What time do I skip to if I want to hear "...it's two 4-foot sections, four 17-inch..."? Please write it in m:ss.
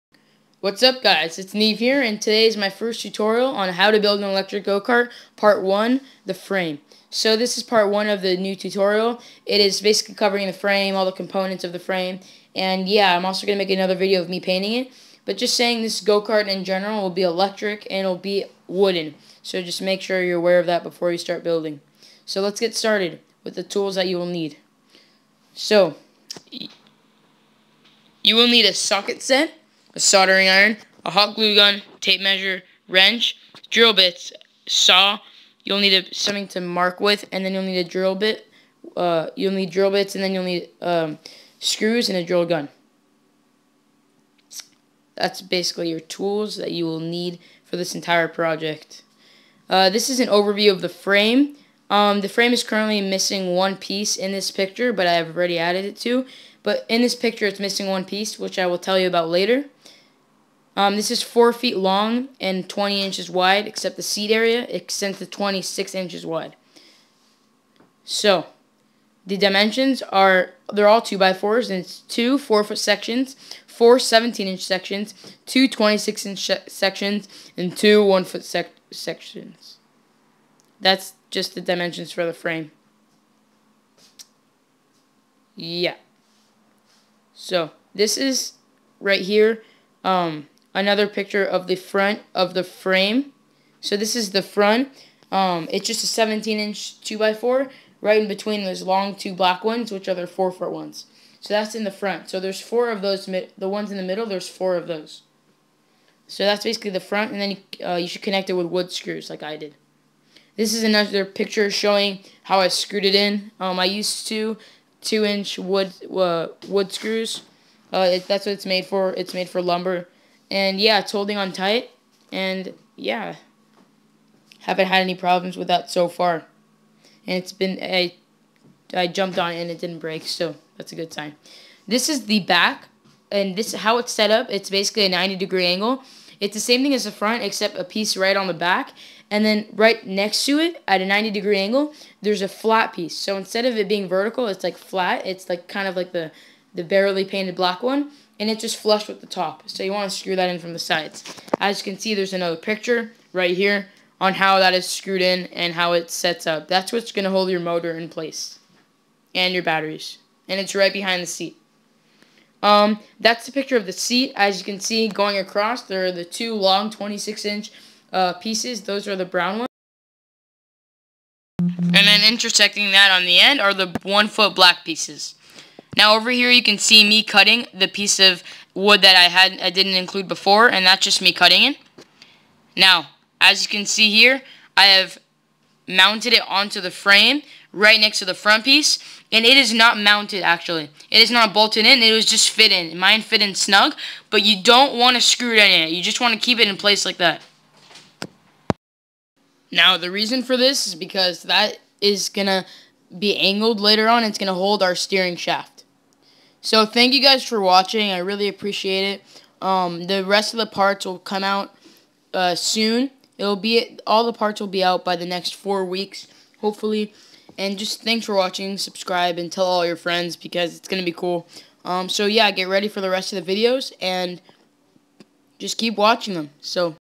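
1:11.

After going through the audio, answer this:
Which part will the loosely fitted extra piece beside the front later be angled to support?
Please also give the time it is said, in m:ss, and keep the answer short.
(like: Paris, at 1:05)
steering shaft, at 3:24.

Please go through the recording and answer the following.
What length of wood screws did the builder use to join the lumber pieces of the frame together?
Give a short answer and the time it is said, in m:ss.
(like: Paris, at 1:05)
2 inch, at 1:55.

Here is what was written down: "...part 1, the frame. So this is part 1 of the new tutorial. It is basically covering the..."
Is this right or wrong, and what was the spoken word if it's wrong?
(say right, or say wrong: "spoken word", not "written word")
right.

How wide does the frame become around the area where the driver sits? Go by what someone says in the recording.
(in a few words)
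26 inches.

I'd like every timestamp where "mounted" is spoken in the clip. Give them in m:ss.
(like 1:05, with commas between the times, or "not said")
3:05, 3:09.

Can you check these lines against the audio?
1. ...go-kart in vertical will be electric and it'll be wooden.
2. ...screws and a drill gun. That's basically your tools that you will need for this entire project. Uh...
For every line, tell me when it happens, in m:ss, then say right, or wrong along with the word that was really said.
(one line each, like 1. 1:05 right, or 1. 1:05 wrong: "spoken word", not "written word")
1. 0:15 wrong: "general", not "vertical"
2. 0:41 right.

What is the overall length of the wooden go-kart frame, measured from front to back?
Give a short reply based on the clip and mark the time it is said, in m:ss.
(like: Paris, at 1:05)
4 feet, at 1:01.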